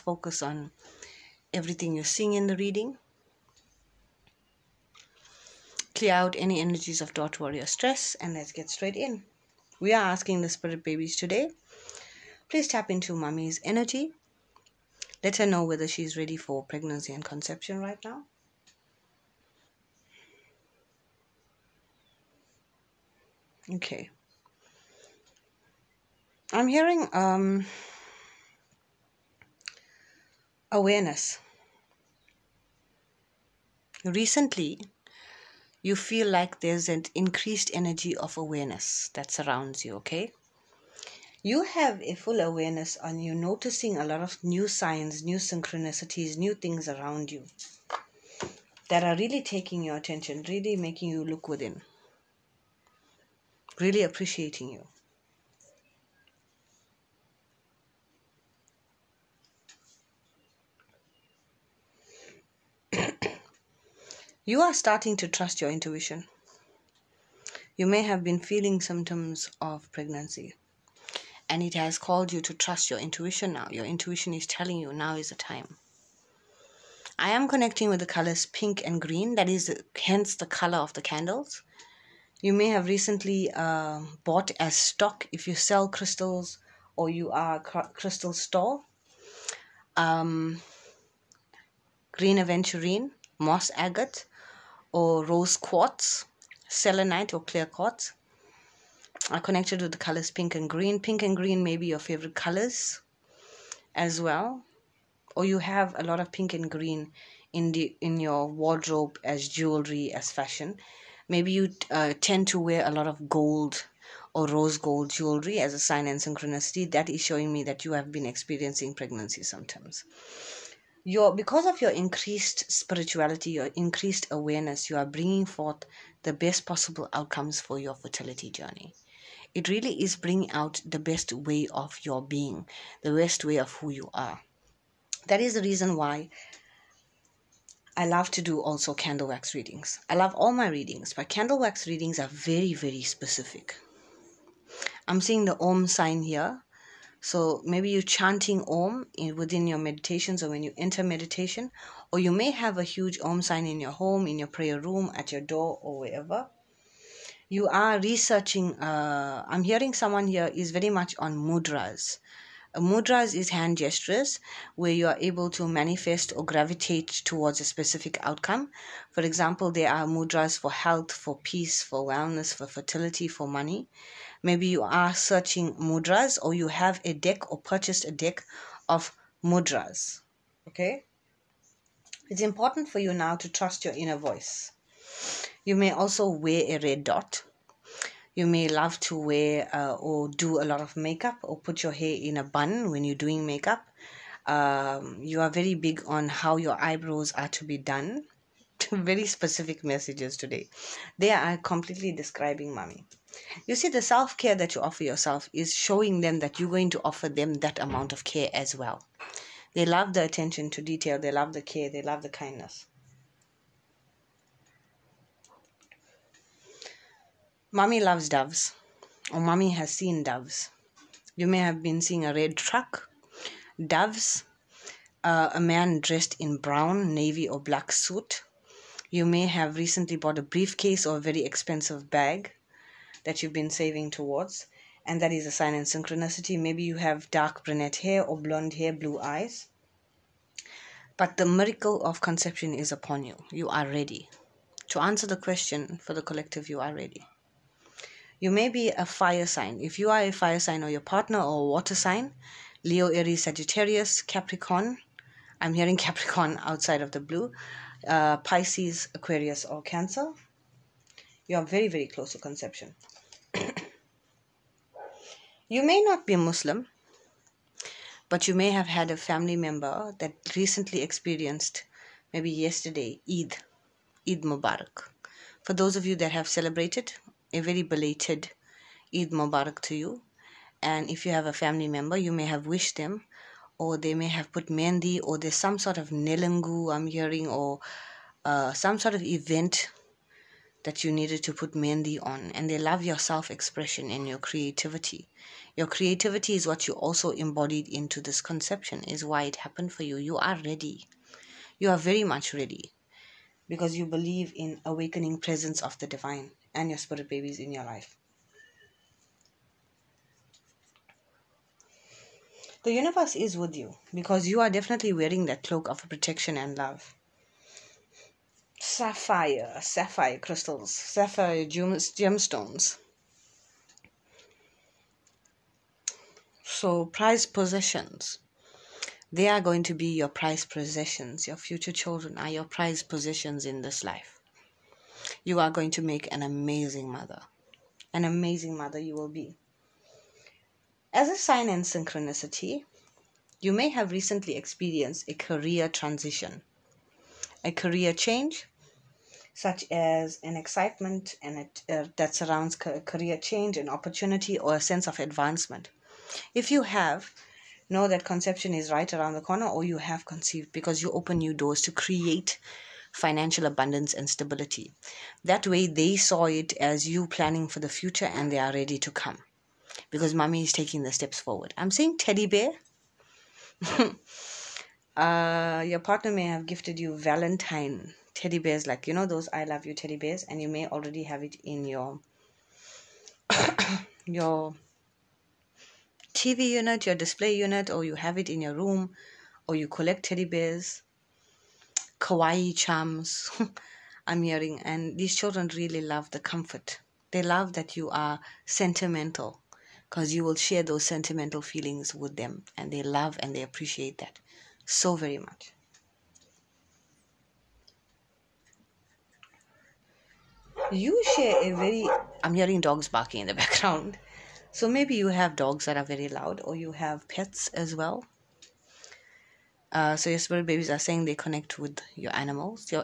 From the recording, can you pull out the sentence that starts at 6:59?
Uh, so your spirit babies are saying they connect with your animals.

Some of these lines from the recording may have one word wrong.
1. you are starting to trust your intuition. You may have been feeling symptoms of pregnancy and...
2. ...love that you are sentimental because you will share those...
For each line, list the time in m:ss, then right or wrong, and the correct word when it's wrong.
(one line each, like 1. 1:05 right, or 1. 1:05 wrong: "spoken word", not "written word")
1. 1:04 right
2. 6:37 right.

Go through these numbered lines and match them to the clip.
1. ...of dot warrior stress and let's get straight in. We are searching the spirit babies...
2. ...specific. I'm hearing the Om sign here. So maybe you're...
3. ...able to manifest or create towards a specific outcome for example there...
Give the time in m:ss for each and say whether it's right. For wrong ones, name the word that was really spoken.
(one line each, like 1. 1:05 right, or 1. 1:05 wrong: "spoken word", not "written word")
1. 0:07 wrong: "asking", not "searching"
2. 2:23 wrong: "seeing", not "hearing"
3. 2:45 wrong: "gravitate", not "create".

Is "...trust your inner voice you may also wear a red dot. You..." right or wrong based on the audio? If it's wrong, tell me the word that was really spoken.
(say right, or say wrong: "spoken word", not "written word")
right.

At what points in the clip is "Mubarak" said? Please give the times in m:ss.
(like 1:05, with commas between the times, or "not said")
4:34, 4:39.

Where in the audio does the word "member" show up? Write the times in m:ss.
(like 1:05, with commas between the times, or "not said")
4:29, 4:41.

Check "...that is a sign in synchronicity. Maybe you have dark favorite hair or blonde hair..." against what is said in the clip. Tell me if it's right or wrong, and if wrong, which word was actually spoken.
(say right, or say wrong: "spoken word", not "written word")
wrong: "brunette", not "favorite".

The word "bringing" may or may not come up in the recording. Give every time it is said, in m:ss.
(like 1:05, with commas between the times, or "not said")
2:05, 2:10.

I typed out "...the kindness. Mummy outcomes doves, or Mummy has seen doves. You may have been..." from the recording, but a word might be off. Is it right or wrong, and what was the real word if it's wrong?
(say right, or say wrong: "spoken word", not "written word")
wrong: "loves", not "outcomes".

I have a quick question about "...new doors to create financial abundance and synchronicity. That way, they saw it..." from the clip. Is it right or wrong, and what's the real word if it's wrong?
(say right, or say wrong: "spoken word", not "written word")
wrong: "stability", not "synchronicity".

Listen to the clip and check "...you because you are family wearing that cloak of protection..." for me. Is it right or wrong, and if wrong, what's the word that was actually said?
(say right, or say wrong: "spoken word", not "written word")
wrong: "definitely", not "family".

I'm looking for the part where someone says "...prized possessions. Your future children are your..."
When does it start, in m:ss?
5:30.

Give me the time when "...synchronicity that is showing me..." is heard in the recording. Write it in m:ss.
1:56.